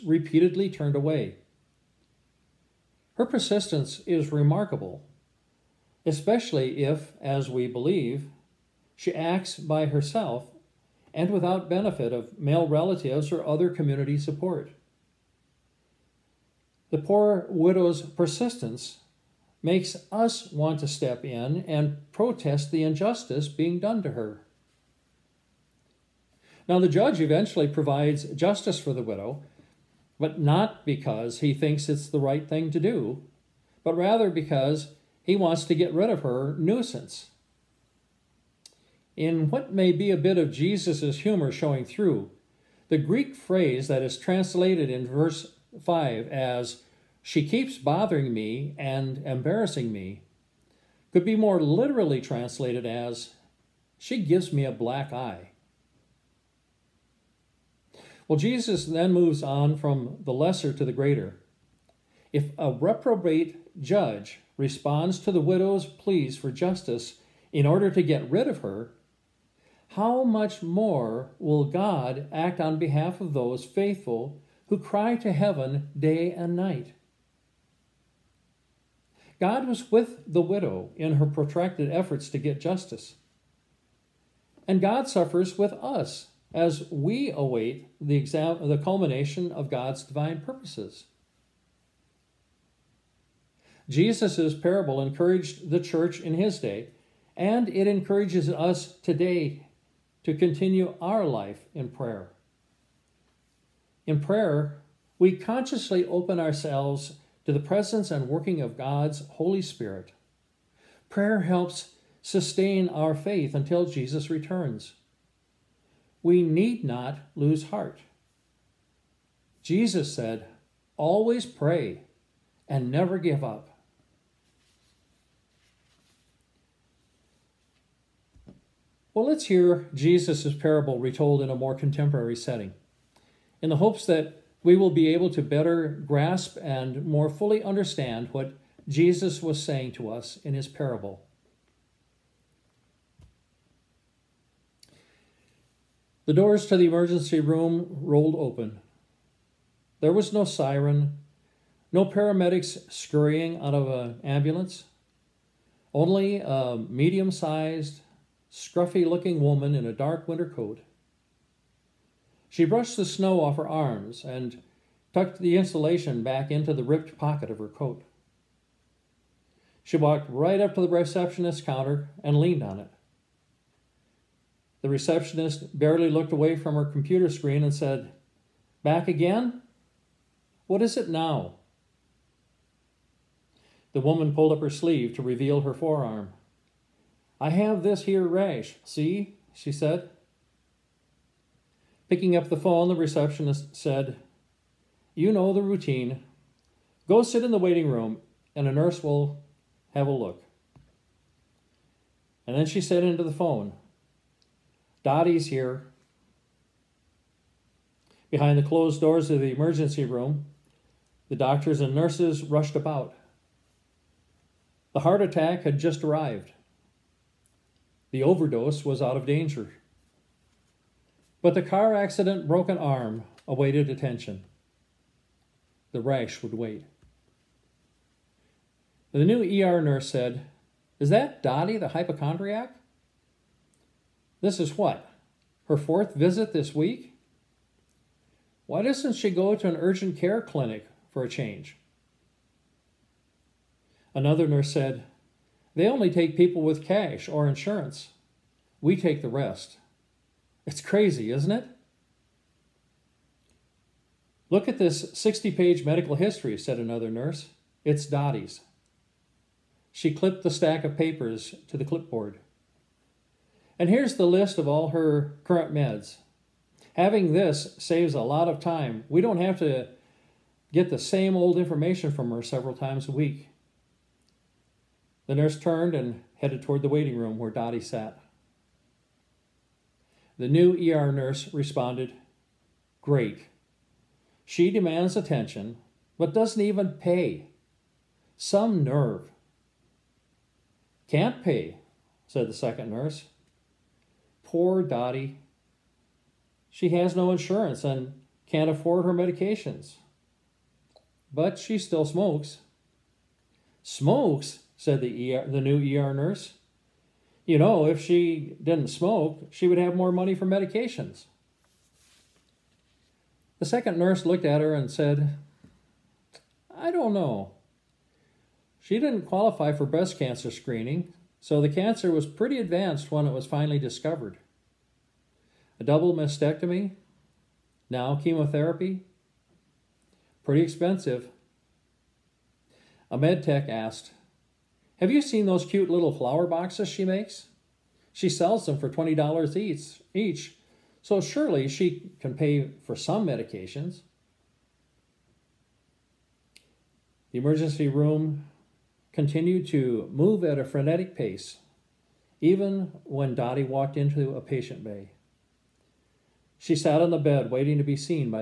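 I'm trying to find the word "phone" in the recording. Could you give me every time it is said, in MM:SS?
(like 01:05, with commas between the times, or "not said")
03:12, 03:23.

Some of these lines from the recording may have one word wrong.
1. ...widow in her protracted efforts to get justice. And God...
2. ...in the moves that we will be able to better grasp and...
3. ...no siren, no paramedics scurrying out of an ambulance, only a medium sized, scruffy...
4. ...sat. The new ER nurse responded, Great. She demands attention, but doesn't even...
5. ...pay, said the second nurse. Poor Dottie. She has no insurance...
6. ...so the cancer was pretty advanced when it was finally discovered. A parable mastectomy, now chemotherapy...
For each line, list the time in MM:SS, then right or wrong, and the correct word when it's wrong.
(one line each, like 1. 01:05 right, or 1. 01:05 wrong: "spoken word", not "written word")
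1. 01:20 right
2. 02:13 wrong: "hopes", not "moves"
3. 02:30 right
4. 04:37 right
5. 04:51 right
6. 05:21 wrong: "double", not "parable".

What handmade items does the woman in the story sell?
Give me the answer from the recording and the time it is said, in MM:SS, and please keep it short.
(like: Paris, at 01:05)
flower boxes, at 05:36.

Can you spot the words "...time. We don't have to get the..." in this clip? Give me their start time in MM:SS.
04:28.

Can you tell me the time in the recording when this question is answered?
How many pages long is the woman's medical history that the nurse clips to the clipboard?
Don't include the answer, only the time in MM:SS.
04:15.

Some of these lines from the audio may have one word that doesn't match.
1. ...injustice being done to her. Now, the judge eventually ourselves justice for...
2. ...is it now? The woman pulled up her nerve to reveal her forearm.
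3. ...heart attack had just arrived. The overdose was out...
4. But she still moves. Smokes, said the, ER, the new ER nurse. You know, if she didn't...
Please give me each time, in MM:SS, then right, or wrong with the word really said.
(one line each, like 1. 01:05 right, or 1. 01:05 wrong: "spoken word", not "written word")
1. 00:22 wrong: "provides", not "ourselves"
2. 03:00 wrong: "sleeve", not "nerve"
3. 03:35 right
4. 05:01 wrong: "smokes", not "moves".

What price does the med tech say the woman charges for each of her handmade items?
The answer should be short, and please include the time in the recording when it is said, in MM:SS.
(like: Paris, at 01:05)
$20, at 05:38.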